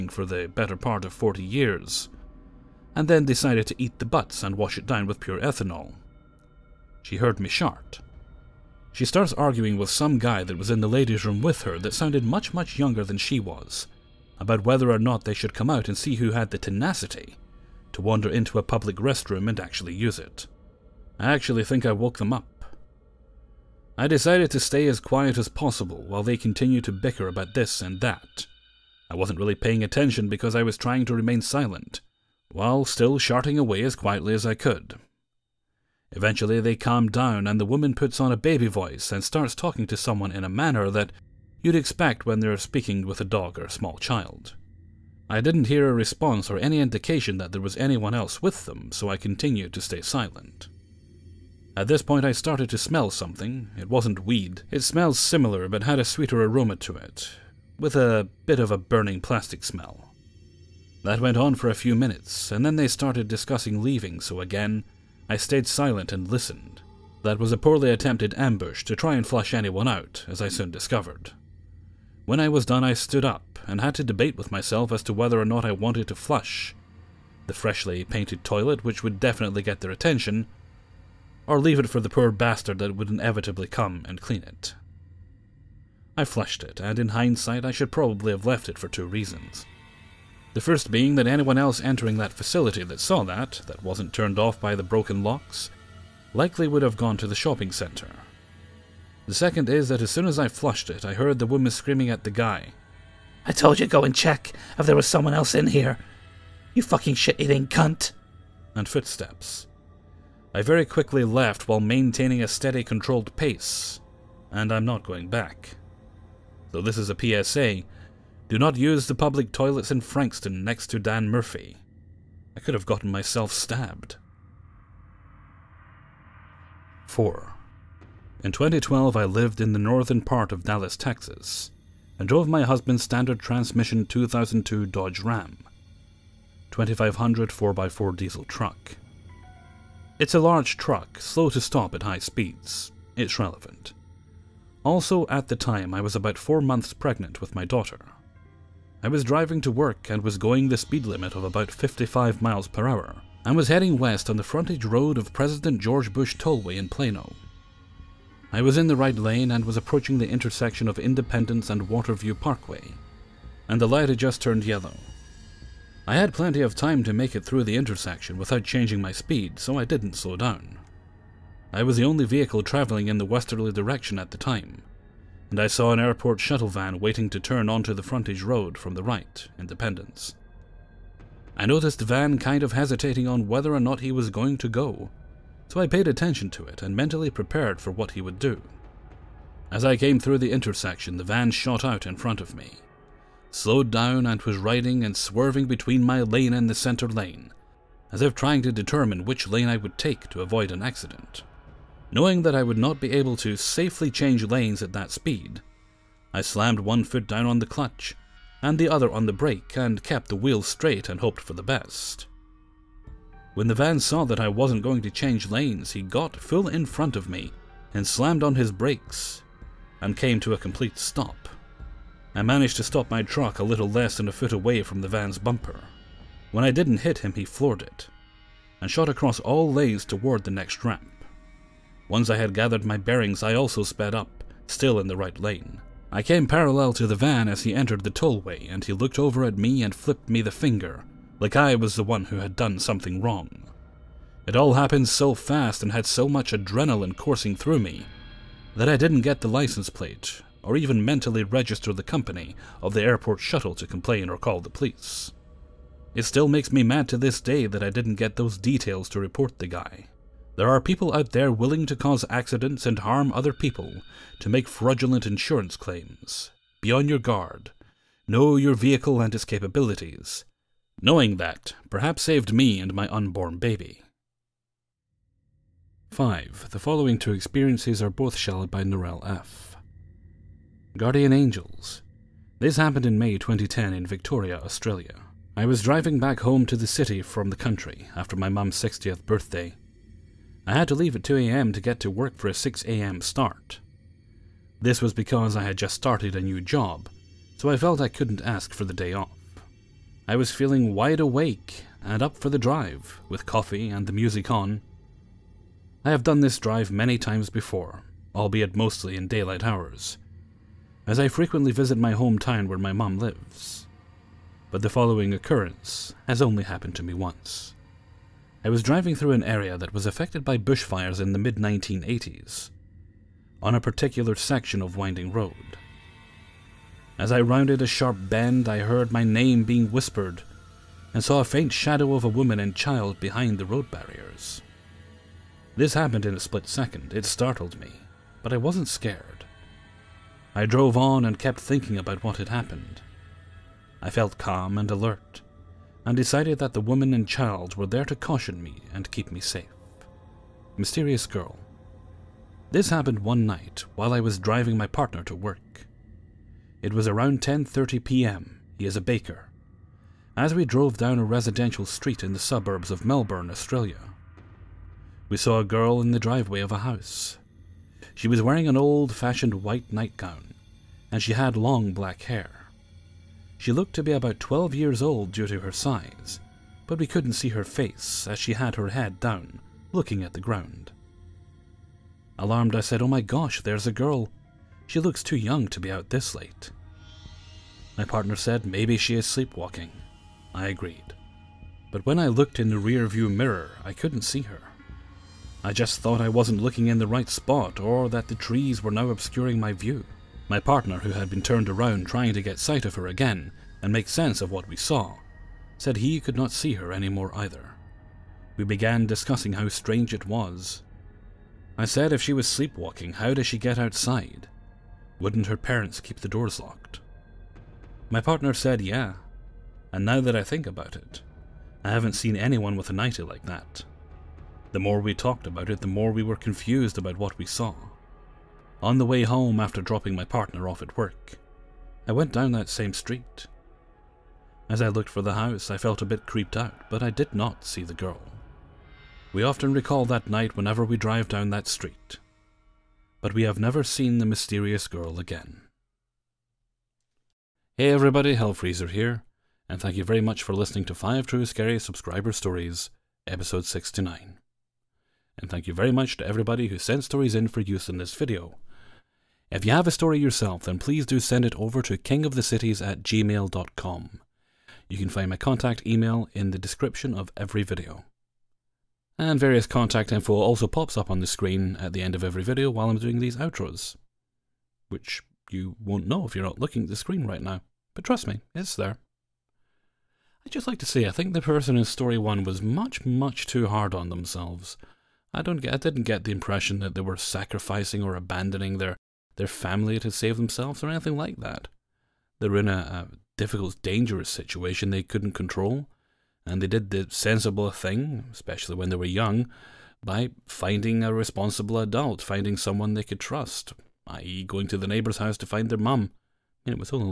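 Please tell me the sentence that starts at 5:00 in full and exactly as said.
I was feeling wide awake and up for the drive, with coffee and the music on.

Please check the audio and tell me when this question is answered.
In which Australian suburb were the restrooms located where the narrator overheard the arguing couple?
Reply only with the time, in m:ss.
2:00.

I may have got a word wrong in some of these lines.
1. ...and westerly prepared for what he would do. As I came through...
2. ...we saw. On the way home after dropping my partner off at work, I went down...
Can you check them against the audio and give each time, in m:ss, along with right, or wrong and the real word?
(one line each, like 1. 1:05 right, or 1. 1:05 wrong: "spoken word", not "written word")
1. 3:06 wrong: "mentally", not "westerly"
2. 7:07 right.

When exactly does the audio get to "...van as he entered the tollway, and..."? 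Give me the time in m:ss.
3:57.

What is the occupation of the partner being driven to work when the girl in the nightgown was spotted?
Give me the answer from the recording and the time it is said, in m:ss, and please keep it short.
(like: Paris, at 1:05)
baker, at 5:58.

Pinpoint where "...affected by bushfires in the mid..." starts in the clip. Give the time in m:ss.
5:20.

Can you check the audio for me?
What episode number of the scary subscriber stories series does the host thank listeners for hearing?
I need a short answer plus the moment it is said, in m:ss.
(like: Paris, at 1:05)
69, at 7:33.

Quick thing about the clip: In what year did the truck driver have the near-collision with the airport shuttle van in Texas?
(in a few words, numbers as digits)
2012.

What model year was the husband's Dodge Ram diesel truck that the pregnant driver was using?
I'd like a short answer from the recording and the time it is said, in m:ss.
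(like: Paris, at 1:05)
2002, at 2:14.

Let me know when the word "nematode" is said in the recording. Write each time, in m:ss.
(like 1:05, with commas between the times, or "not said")
not said.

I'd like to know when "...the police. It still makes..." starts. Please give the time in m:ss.
4:14.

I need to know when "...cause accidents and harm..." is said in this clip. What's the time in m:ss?
4:21.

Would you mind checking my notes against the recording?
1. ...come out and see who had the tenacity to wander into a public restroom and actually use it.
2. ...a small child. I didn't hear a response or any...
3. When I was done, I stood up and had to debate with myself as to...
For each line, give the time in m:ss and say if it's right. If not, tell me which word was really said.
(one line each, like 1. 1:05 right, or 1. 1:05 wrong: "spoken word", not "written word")
1. 0:15 right
2. 0:43 right
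3. 1:12 right.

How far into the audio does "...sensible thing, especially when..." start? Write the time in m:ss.
8:17.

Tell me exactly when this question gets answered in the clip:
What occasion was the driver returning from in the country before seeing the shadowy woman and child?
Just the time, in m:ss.
4:48.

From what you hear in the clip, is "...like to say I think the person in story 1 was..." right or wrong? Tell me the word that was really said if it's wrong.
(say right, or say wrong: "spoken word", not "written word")
right.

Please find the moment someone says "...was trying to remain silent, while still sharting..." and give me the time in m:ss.
0:30.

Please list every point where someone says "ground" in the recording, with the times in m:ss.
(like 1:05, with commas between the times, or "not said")
6:20.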